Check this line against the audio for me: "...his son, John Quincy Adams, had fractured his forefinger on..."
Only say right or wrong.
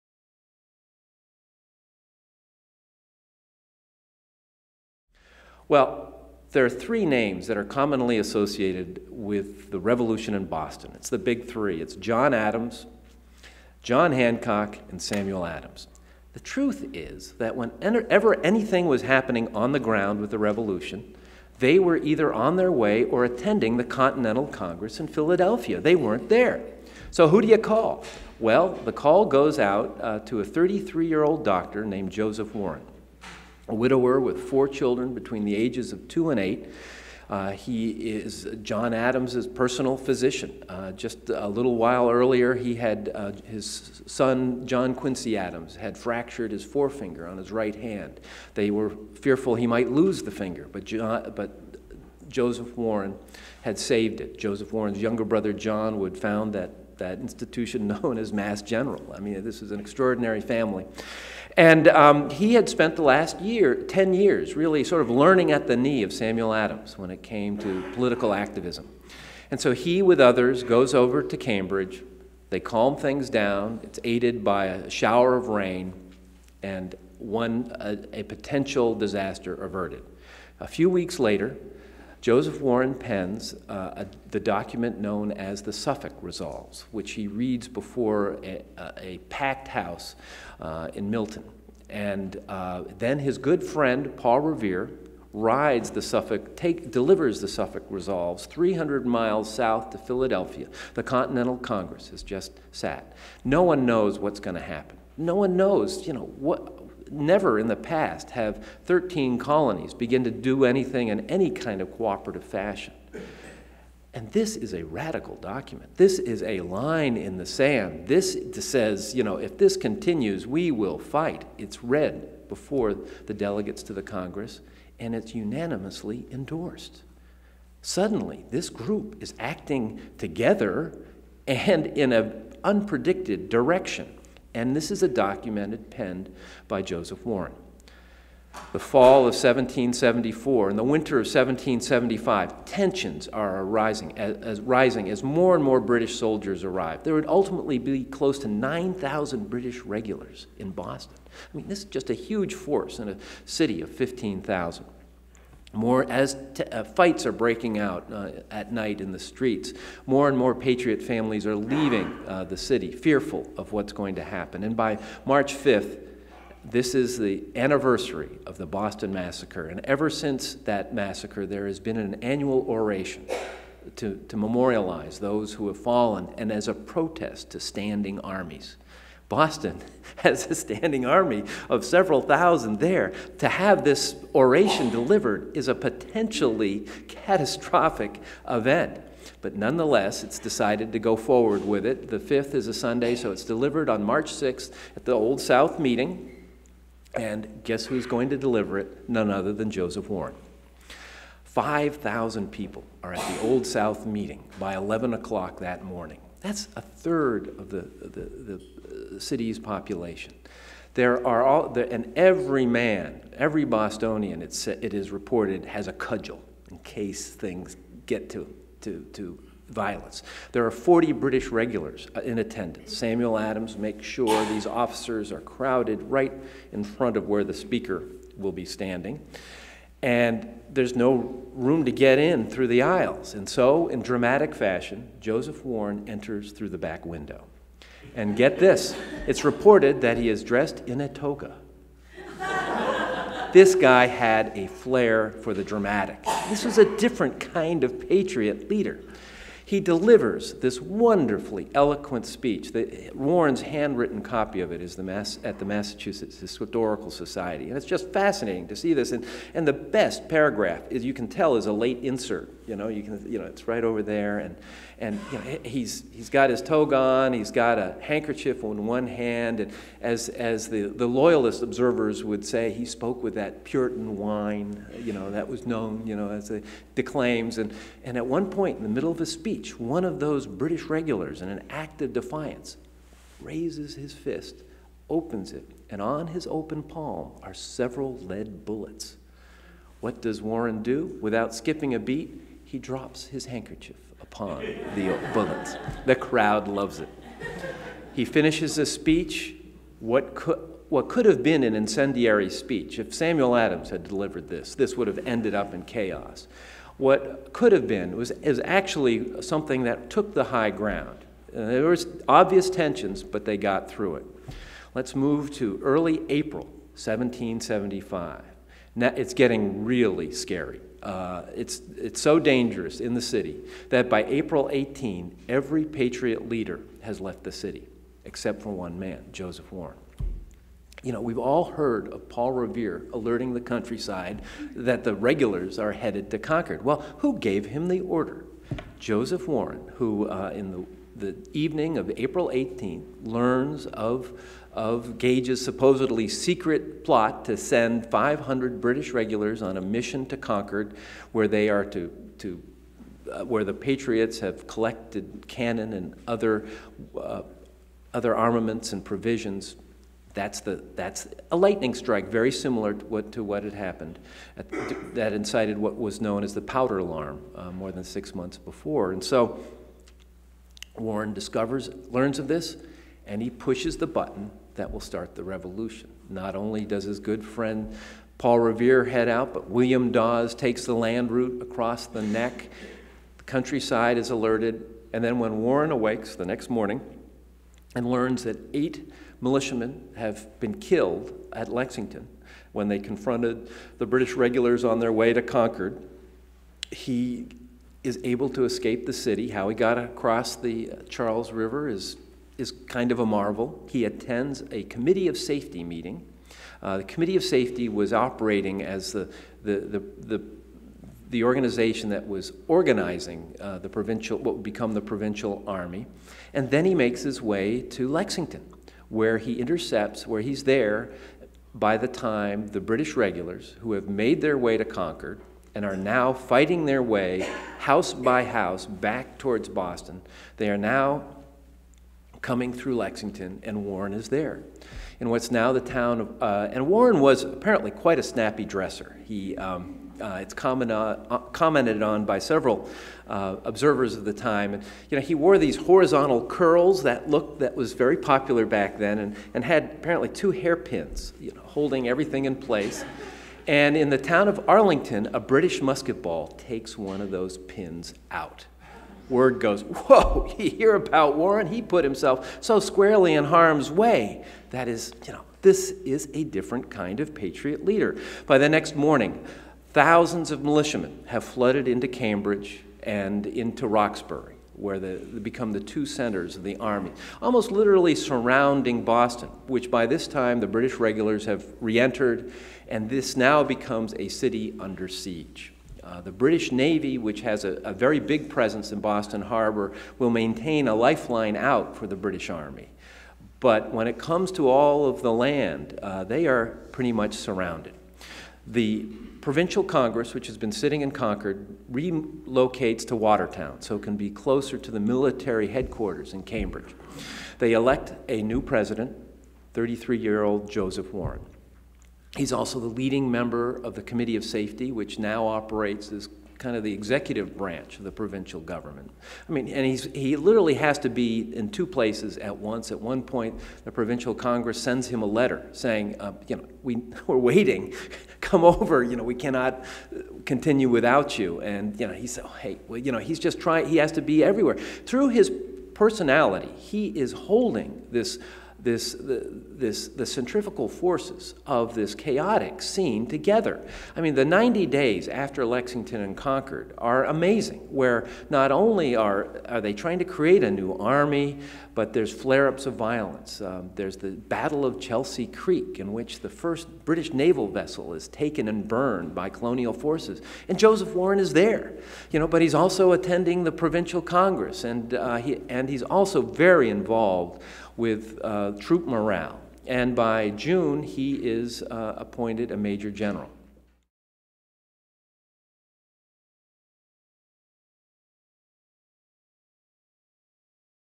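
right.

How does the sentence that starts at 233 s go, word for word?
And so, in dramatic fashion, Joseph Warren enters through the back window.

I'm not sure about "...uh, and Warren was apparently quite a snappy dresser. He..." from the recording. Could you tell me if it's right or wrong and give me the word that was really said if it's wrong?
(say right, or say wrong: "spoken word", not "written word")
right.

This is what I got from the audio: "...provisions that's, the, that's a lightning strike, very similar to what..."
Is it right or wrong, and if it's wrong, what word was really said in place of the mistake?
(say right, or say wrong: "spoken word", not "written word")
right.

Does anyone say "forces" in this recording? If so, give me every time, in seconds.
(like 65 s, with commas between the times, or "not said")
152 s, 540 s, 559 s.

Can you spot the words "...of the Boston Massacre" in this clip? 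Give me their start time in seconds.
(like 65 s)
168 s.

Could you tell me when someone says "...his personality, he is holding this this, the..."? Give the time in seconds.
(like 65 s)
535 s.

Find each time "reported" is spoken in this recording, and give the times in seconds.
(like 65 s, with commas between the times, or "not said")
215 s, 239 s.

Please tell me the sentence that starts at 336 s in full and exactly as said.
Well, who gave him the order?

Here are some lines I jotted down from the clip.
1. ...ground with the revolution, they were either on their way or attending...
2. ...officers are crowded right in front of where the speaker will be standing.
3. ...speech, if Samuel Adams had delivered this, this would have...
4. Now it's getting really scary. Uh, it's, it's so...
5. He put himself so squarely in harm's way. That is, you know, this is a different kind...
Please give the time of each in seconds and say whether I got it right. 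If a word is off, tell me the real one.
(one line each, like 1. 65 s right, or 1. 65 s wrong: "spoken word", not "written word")
1. 19 s right
2. 224 s right
3. 302 s right
4. 318 s right
5. 461 s right.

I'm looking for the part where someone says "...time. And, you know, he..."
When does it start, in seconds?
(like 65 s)
444 s.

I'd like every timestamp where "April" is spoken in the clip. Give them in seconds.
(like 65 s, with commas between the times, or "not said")
316 s, 324 s, 342 s.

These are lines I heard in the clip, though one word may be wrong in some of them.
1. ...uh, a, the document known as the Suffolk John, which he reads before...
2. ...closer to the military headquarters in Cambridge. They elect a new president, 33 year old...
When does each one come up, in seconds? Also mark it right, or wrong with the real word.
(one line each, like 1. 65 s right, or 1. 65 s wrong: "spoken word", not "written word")
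1. 83 s wrong: "Resolves", not "John"
2. 504 s right.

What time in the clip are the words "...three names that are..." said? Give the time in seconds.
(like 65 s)
6 s.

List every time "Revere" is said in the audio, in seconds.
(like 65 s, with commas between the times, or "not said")
94 s, 332 s, 378 s.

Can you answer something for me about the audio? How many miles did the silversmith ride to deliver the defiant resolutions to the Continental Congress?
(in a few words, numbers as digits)
300.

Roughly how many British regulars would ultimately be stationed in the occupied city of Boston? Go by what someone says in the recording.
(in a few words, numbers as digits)
9,000.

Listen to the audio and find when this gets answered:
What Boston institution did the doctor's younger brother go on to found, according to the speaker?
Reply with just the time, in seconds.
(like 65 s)
58 s.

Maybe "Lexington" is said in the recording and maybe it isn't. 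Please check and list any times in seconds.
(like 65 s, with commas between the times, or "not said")
391 s, 418 s, 432 s, 545 s.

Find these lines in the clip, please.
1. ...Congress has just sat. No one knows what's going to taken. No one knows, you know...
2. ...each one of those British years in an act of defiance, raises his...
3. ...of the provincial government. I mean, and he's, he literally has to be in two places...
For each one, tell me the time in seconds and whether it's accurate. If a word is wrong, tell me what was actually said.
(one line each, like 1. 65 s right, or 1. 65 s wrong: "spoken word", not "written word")
1. 101 s wrong: "happen", not "taken"
2. 279 s wrong: "regulars", not "years"
3. 517 s right.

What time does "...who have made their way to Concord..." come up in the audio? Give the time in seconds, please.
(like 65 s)
423 s.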